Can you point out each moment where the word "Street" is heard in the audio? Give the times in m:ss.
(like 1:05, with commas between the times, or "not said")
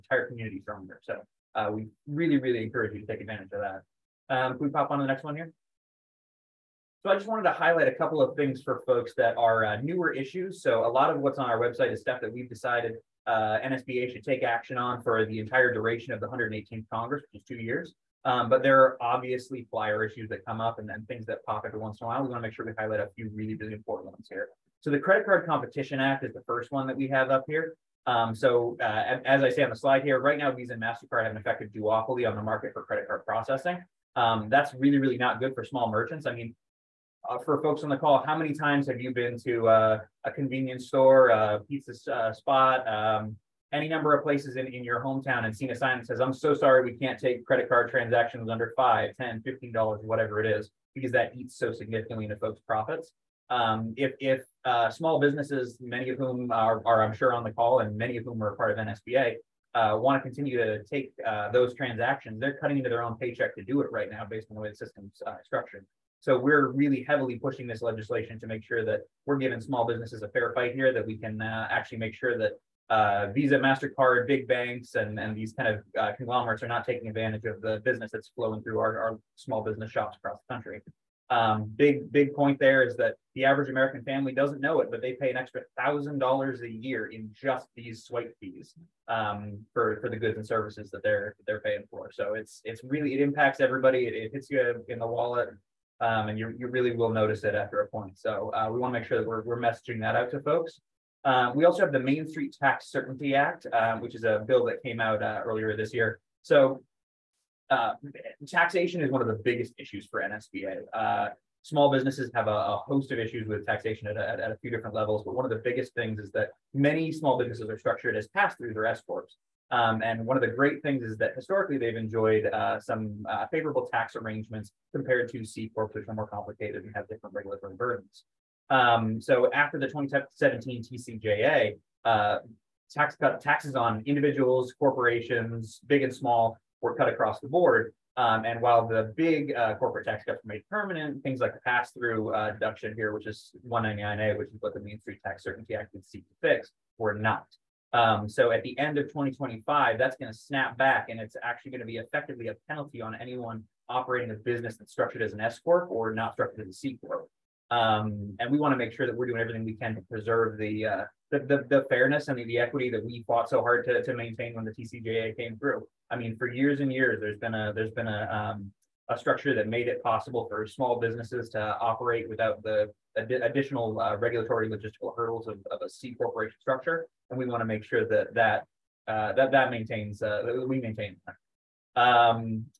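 1:42, 2:24.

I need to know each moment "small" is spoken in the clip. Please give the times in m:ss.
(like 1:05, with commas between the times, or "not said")
0:35, 0:54, 1:09, 1:19, 1:51, 1:57, 2:16, 2:50.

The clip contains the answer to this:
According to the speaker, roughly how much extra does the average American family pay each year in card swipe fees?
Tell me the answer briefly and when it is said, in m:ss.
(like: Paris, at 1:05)
$1,000, at 1:25.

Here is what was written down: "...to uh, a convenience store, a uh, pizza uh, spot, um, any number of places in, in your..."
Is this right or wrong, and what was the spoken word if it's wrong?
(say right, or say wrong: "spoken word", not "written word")
right.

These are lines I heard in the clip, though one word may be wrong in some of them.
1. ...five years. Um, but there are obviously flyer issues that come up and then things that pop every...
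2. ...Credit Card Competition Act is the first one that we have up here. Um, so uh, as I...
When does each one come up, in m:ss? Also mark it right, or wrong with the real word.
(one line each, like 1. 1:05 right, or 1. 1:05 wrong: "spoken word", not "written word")
1. 0:17 wrong: "two", not "five"
2. 0:24 right.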